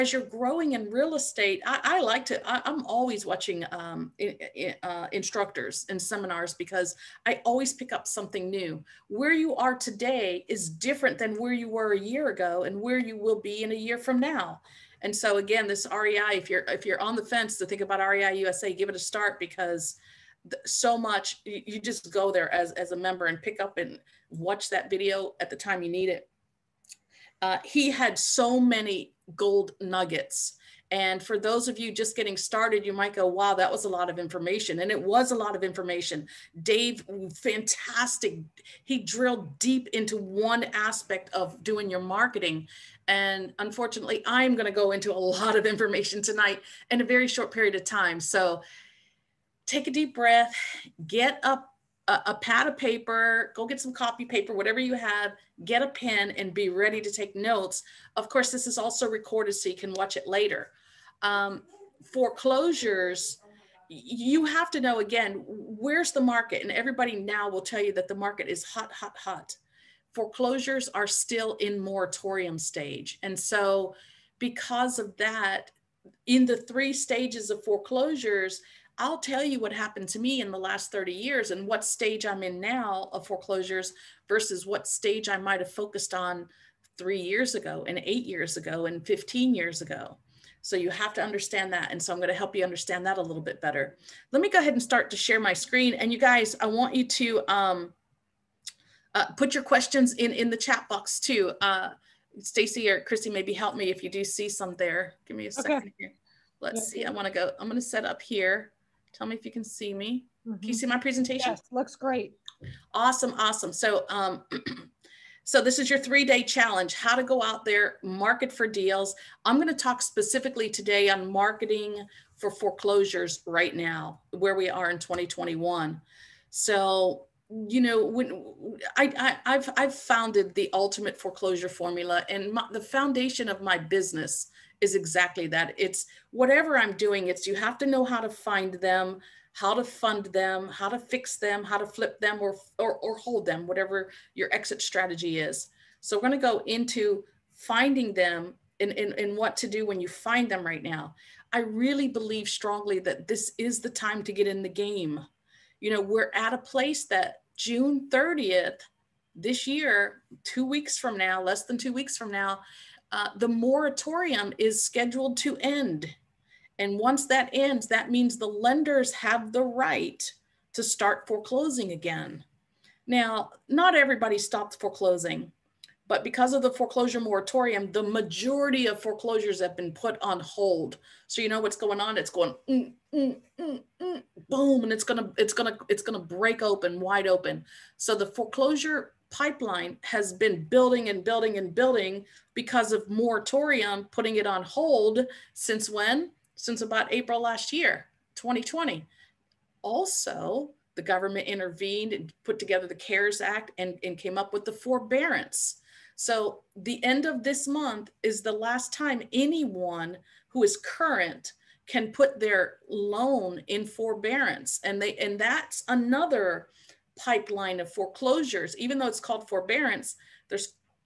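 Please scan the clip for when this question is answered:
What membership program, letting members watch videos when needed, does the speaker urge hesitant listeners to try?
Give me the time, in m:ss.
0:17.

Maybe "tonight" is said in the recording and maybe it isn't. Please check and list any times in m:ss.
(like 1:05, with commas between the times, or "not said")
0:46.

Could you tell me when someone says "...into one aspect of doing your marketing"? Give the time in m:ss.
0:39.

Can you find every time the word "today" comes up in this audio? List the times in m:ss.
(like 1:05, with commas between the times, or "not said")
0:09, 2:00.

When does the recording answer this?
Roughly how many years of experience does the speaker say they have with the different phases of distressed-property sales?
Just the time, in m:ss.
1:20.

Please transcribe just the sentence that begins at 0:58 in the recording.
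Of course, this is also recorded so you can watch it later.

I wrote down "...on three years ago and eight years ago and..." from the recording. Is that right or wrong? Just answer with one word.
right.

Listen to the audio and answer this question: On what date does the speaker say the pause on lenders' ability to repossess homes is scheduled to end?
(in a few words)
June 30th.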